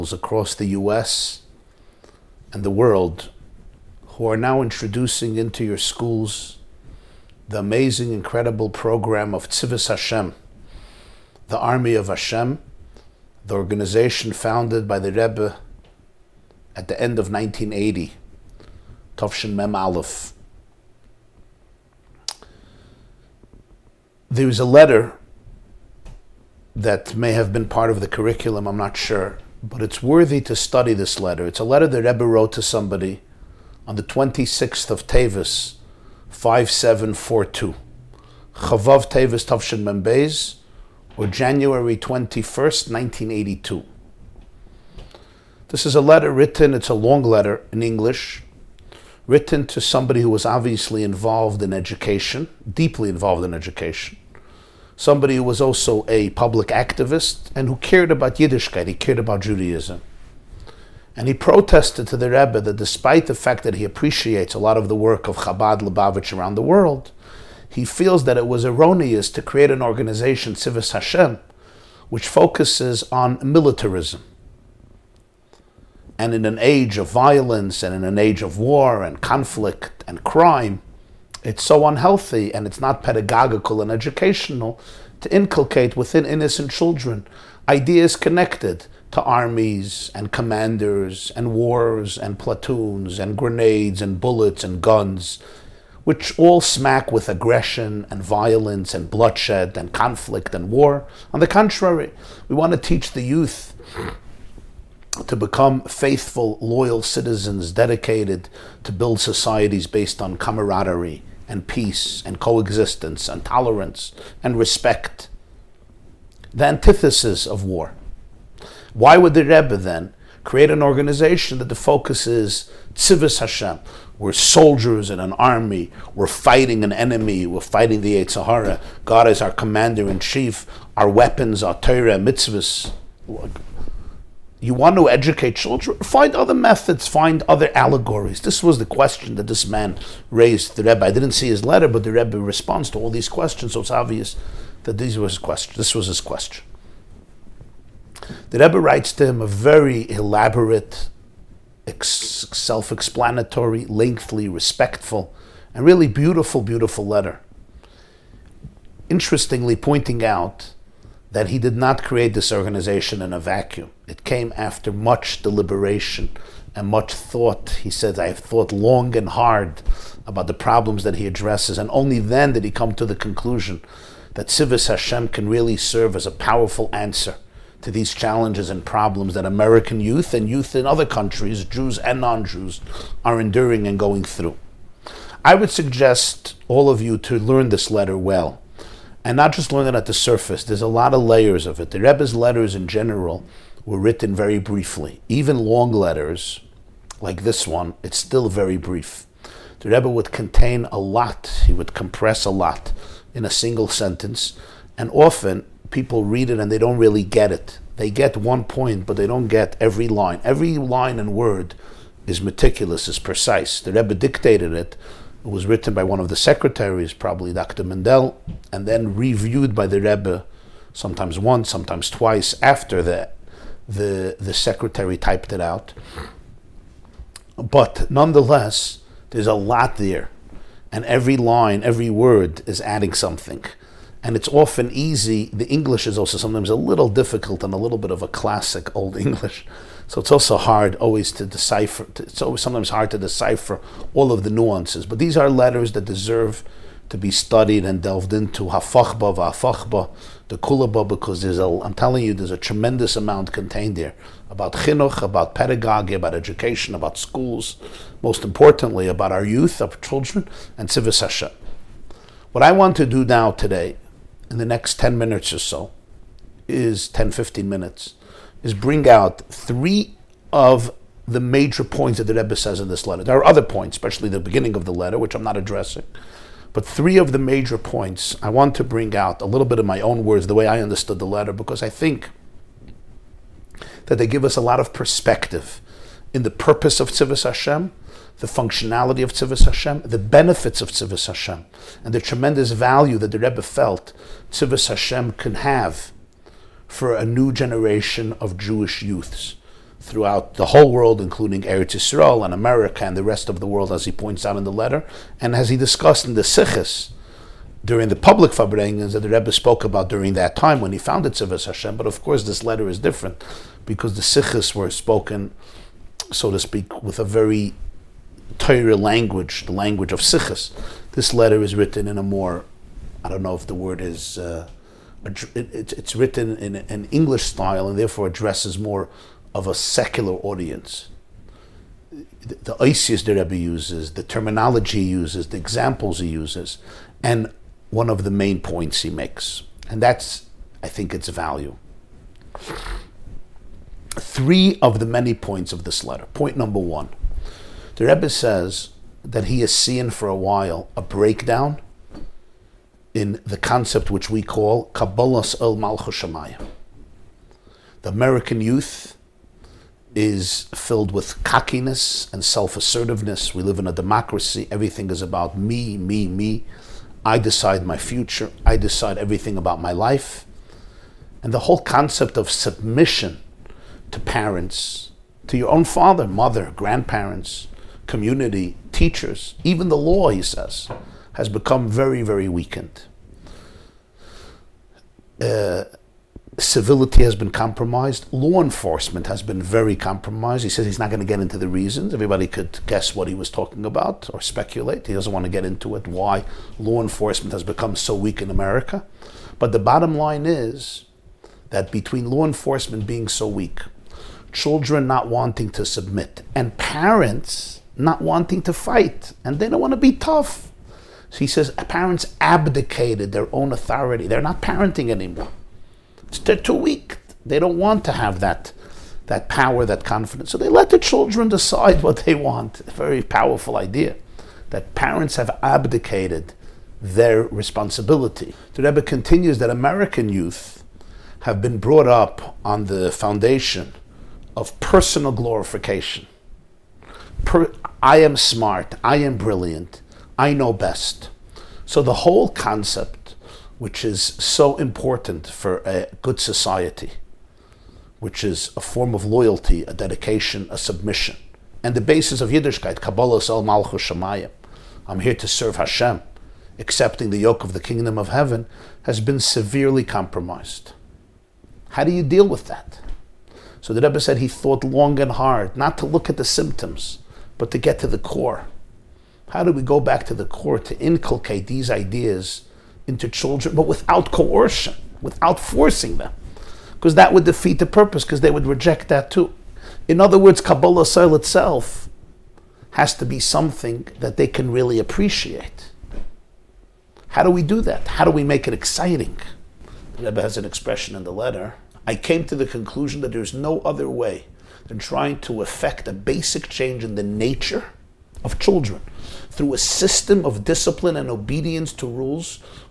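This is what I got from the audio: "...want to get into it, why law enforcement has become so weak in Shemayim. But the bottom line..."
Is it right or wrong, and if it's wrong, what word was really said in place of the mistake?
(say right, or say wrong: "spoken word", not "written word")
wrong: "America", not "Shemayim".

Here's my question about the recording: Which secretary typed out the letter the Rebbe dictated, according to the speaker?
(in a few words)
Dr. Mindel.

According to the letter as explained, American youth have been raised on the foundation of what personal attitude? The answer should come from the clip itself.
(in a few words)
personal glorification.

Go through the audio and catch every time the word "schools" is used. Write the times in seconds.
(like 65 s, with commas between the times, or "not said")
5 s, 257 s.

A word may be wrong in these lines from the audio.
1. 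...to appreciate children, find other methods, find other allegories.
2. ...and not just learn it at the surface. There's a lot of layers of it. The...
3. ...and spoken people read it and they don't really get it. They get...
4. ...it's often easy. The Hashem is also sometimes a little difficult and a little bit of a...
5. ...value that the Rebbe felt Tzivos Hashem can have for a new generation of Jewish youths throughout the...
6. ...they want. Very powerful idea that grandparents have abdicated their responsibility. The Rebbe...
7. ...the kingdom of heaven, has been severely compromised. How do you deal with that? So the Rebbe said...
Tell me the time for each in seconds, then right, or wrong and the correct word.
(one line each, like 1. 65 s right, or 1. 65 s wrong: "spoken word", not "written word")
1. 134 s wrong: "educate", not "appreciate"
2. 189 s right
3. 204 s wrong: "often", not "spoken"
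4. 234 s wrong: "English", not "Hashem"
5. 292 s right
6. 422 s wrong: "parents", not "grandparents"
7. 457 s right.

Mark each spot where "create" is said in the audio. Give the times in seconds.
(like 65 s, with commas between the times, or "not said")
69 s, 120 s, 162 s.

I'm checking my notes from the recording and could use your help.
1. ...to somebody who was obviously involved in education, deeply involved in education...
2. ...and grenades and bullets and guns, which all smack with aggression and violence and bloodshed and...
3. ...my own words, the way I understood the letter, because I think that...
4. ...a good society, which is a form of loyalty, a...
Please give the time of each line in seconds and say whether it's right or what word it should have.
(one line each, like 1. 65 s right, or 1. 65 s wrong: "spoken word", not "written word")
1. 49 s right
2. 93 s right
3. 279 s right
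4. 445 s right.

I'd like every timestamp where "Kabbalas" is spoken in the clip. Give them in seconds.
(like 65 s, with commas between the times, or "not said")
354 s, 452 s, 480 s.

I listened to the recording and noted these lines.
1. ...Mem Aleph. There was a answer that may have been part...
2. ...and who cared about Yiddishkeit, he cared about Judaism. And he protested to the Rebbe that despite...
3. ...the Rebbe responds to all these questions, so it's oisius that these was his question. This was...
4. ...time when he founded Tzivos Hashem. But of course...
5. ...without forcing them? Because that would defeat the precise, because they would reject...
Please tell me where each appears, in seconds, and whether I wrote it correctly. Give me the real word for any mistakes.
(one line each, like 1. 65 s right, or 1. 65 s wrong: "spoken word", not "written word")
1. 19 s wrong: "letter", not "answer"
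2. 57 s right
3. 142 s wrong: "obvious", not "oisius"
4. 310 s right
5. 475 s wrong: "purpose", not "precise".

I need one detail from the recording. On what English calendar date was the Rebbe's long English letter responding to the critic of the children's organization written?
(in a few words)
January 21st, 1982.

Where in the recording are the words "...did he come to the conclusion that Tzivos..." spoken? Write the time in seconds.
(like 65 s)
172 s.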